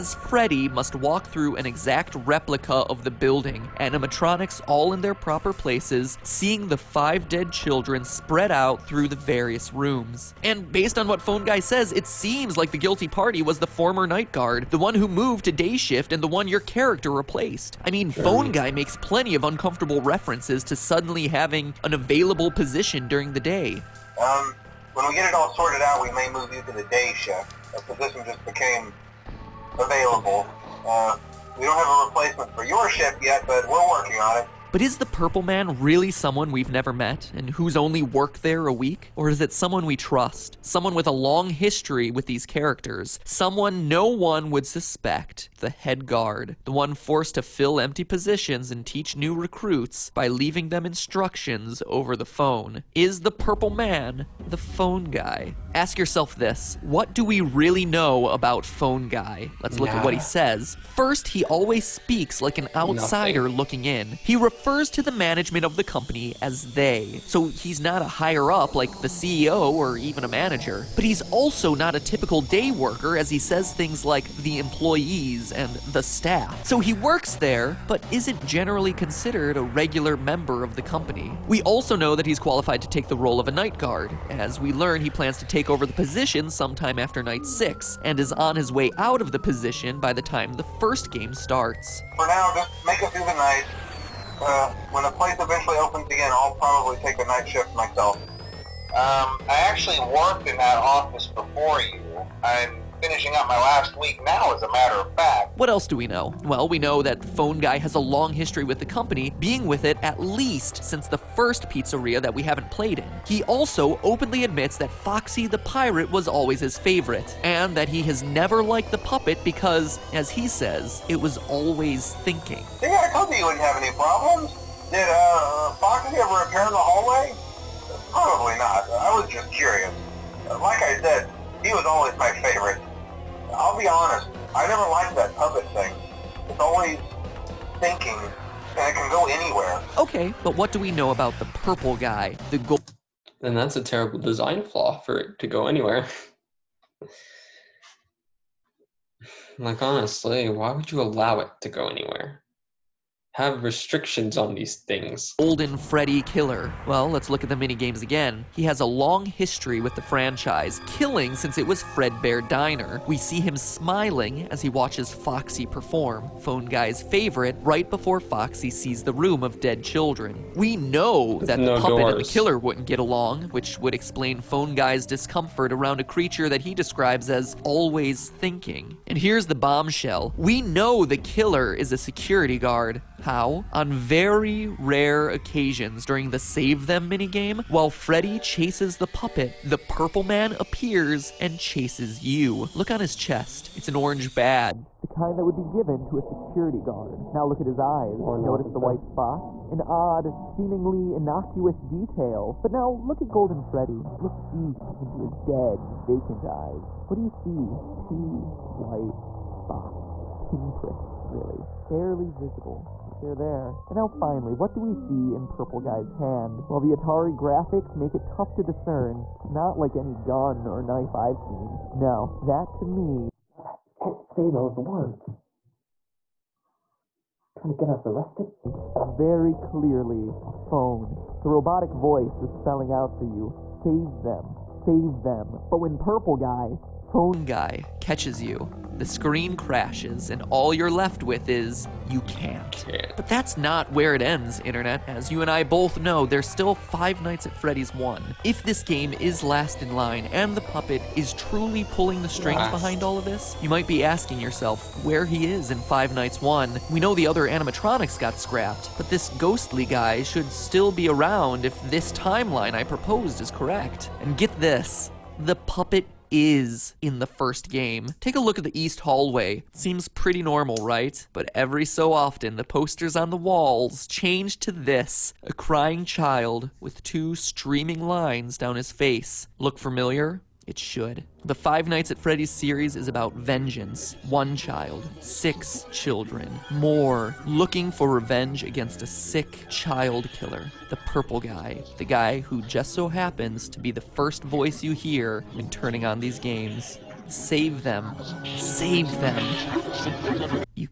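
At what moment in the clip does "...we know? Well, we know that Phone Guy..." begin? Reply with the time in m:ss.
1:45.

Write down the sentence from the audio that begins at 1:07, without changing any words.
So he's not a higher up like the CEO or even a manager.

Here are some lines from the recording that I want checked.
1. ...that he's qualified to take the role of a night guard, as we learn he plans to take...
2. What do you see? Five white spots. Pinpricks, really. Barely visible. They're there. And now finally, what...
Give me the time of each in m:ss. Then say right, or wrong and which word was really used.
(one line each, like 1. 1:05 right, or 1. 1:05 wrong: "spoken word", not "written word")
1. 1:22 right
2. 3:27 wrong: "Two", not "Five".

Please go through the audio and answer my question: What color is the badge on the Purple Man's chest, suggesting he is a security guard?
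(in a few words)
Orange.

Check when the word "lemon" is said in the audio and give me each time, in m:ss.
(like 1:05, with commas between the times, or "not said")
not said.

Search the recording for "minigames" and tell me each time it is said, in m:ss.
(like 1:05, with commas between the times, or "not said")
2:37, 3:07.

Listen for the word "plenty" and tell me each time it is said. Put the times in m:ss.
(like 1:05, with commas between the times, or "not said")
0:18.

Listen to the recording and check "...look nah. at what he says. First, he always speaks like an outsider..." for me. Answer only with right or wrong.
right.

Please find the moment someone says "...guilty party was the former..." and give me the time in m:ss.
0:12.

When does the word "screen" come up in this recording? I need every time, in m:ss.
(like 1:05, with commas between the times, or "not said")
3:59.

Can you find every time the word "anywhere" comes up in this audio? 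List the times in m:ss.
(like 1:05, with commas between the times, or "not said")
2:19, 2:25, 2:31.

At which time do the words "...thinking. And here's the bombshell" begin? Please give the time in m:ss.
2:58.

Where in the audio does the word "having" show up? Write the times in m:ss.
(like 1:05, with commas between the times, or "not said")
0:21.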